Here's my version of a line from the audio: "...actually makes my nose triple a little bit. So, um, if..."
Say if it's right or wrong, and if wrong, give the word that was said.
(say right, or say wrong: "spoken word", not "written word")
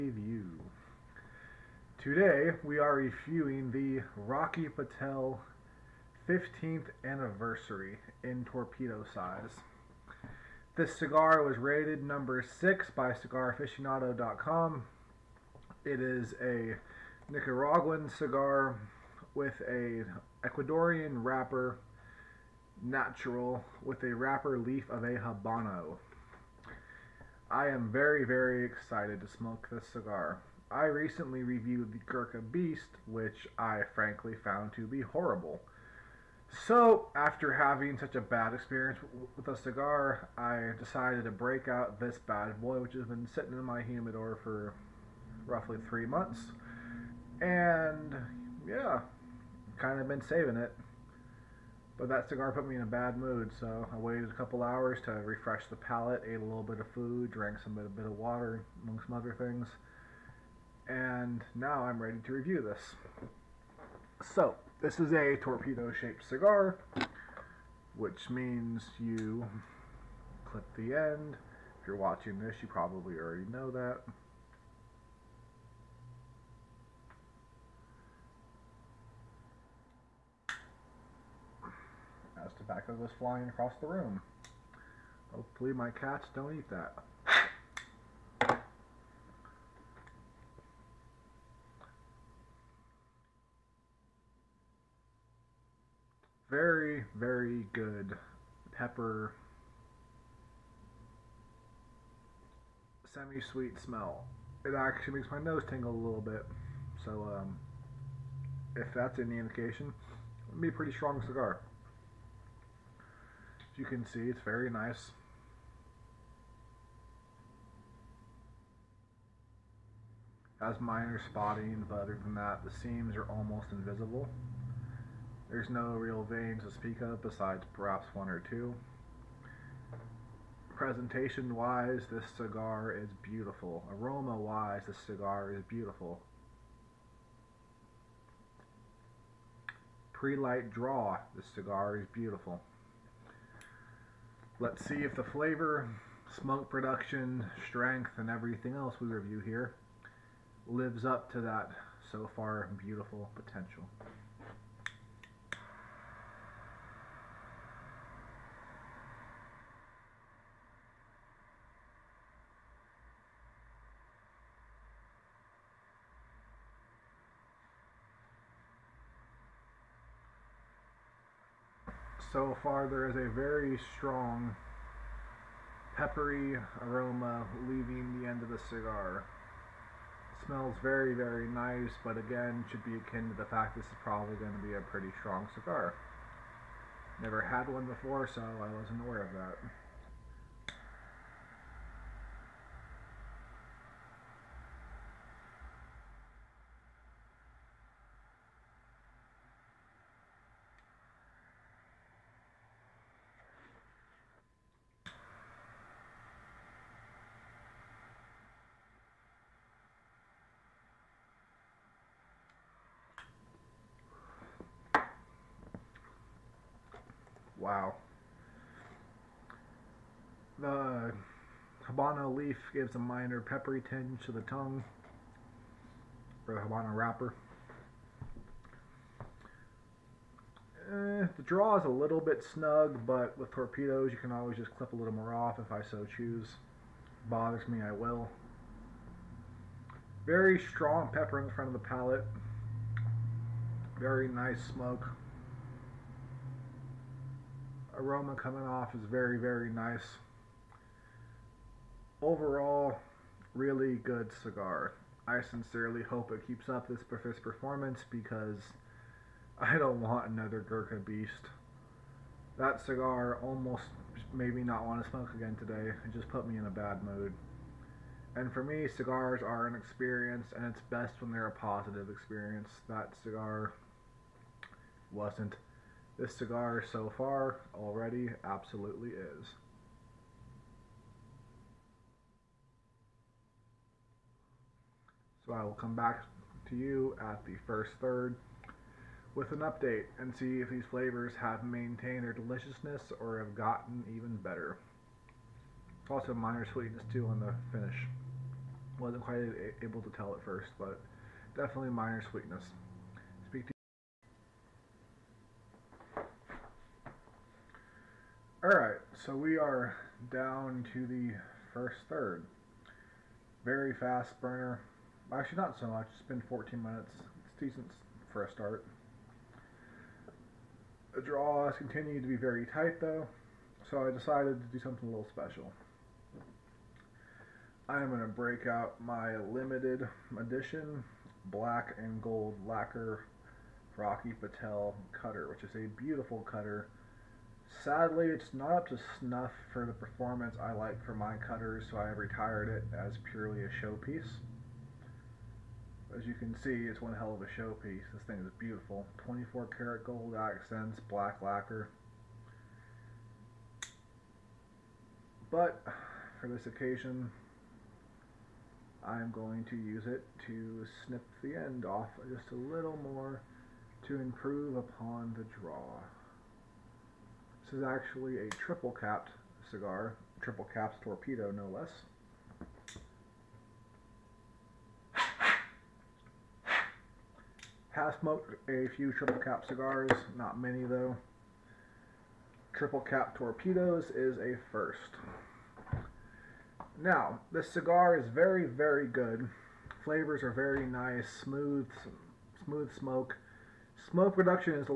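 wrong: "tingle", not "triple".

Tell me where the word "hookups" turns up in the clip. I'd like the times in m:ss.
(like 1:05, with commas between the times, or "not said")
not said.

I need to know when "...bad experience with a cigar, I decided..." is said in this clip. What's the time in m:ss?
0:38.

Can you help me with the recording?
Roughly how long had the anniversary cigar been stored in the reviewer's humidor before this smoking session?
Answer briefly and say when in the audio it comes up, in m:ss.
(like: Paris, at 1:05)
three months, at 0:45.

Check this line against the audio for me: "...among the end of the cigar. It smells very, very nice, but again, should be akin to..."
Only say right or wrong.
wrong.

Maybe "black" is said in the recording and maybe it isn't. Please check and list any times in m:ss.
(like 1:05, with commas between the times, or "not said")
5:31, 5:51.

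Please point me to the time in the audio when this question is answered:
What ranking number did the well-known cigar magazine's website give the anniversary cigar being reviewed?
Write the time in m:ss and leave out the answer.
0:12.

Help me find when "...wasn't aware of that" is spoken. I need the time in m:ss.
3:08.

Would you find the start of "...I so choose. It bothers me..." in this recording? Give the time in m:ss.
3:55.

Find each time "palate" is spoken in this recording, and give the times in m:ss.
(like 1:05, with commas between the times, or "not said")
0:55, 4:01.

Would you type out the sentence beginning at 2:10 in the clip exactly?
Presentation wise, this cigar is beautiful.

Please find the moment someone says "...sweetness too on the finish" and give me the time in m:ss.
4:56.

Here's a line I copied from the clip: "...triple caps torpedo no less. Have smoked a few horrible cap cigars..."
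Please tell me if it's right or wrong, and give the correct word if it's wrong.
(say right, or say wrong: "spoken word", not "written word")
wrong: "triple", not "horrible".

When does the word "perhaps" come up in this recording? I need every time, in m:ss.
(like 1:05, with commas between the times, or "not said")
2:07.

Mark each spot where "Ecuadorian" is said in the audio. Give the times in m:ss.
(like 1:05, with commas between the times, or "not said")
0:20.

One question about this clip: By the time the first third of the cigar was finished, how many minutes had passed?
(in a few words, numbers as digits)
14.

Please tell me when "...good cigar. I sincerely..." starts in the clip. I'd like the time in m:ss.
4:13.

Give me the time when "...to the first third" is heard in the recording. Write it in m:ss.
5:10.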